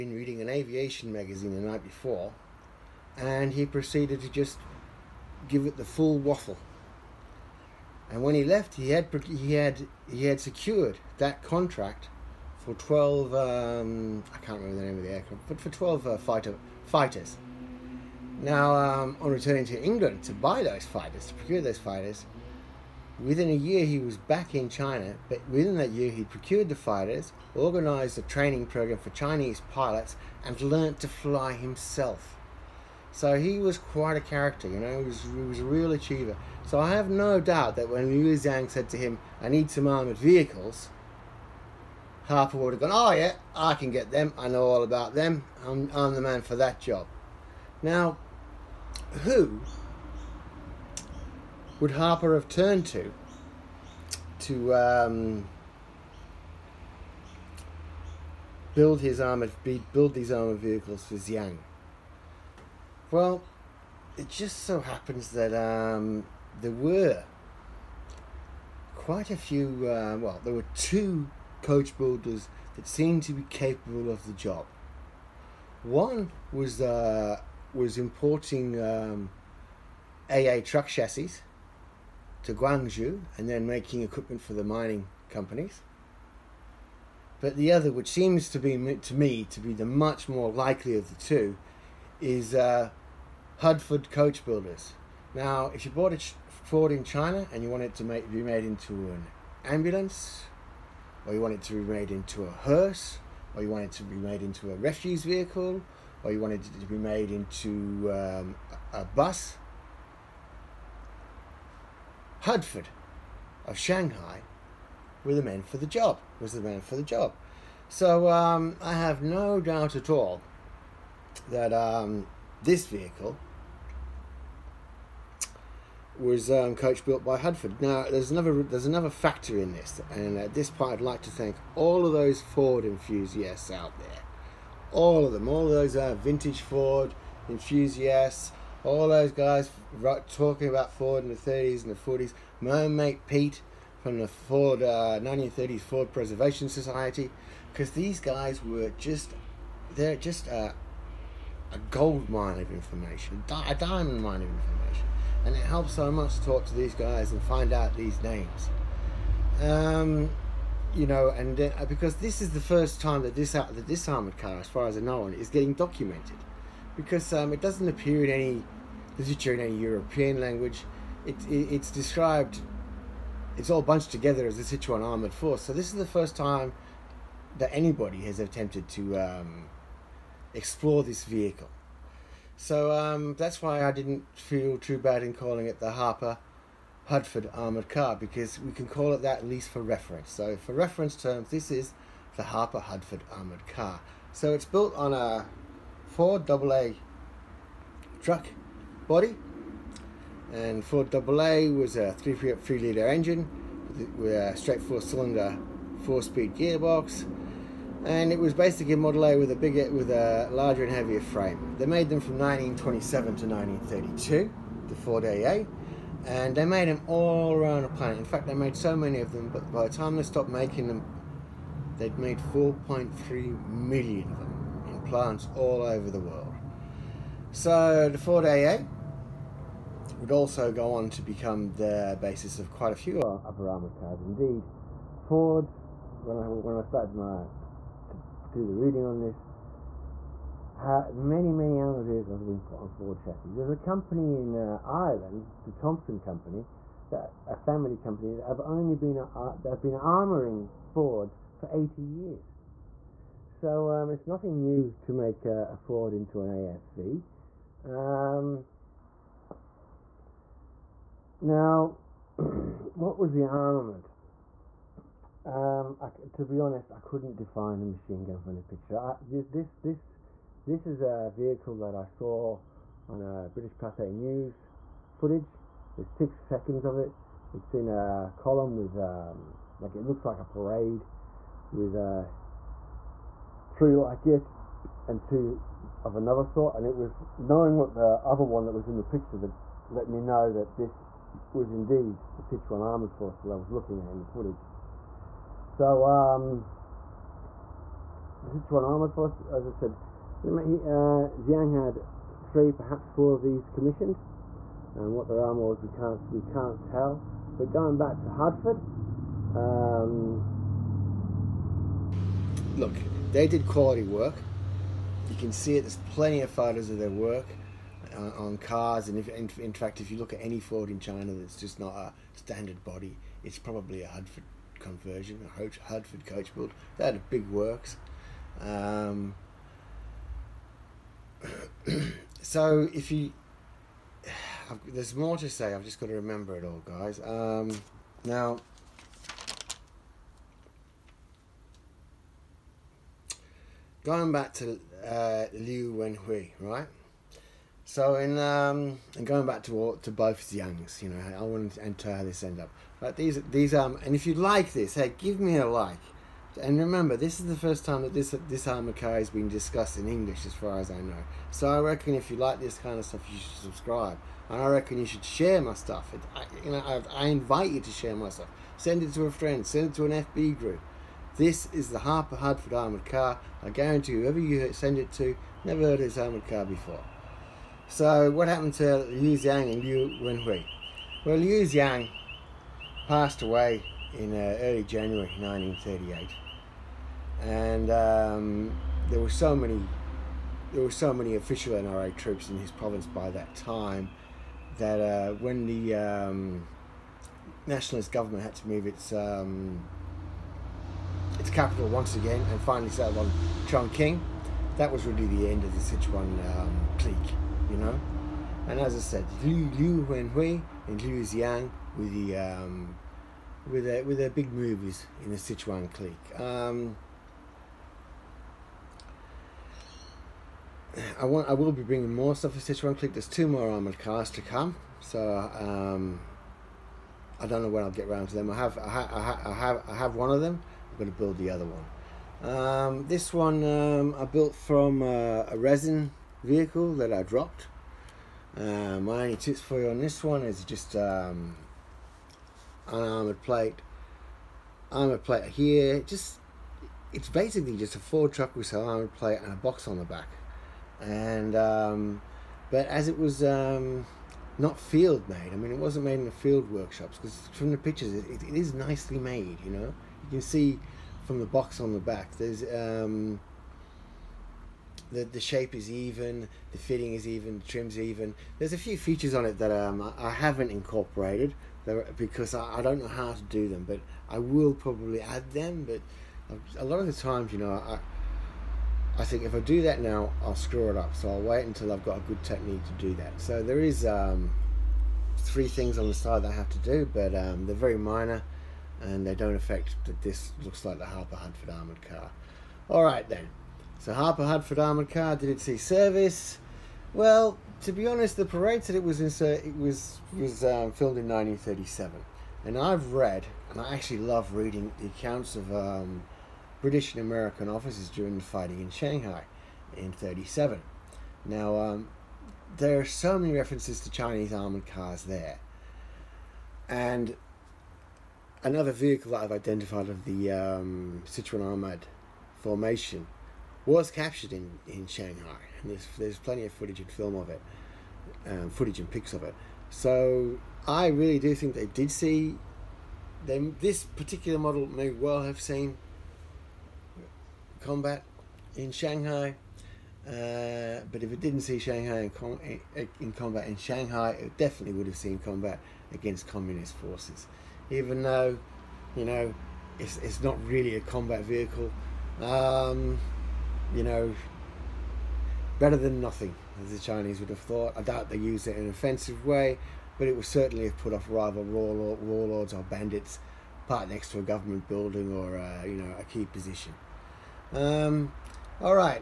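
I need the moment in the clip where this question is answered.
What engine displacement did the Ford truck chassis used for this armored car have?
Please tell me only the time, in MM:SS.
03:22.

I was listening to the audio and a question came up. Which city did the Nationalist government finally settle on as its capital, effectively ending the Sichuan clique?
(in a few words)
Chongqing.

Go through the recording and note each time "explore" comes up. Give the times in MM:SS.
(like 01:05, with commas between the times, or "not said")
03:00.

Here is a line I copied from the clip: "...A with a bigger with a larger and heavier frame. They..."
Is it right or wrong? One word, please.
right.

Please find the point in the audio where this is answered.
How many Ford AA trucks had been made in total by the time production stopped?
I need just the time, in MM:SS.
03:42.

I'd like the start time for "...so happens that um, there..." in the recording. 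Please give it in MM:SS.
01:04.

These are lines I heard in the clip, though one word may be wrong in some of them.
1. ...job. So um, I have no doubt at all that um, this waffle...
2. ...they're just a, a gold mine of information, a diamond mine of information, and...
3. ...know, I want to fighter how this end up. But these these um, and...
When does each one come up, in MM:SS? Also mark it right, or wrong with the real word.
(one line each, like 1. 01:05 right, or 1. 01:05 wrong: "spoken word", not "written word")
1. 01:57 wrong: "vehicle", not "waffle"
2. 02:29 right
3. 05:51 wrong: "enter", not "fighter".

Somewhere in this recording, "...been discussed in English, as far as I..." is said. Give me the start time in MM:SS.
05:59.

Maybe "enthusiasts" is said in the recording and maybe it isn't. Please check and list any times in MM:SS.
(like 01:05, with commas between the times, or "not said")
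02:12, 02:17.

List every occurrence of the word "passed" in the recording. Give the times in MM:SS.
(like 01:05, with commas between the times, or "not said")
06:23.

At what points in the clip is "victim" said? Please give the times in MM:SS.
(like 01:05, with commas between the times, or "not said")
not said.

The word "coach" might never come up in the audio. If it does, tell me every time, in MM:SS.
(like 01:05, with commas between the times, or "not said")
01:11, 01:34, 02:06, 05:26.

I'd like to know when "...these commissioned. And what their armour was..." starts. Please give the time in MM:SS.
05:03.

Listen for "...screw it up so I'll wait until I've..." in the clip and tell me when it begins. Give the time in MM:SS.
08:00.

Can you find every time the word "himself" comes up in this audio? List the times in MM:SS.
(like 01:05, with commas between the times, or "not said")
00:31.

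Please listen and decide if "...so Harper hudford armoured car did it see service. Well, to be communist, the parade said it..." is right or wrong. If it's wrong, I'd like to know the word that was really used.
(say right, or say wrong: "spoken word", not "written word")
wrong: "honest", not "communist".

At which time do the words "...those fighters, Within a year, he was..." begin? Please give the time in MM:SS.
00:21.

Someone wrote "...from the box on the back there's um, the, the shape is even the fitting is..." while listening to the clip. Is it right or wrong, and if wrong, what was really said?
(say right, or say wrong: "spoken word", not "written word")
right.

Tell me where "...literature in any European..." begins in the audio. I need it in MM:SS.
02:49.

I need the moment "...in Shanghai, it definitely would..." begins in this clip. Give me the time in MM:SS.
09:03.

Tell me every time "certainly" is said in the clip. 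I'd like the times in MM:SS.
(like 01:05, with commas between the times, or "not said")
09:20.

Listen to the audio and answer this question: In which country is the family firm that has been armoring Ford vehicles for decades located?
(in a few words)
Ireland.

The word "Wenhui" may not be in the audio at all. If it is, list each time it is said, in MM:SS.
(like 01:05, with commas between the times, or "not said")
05:45, 06:20, 06:50.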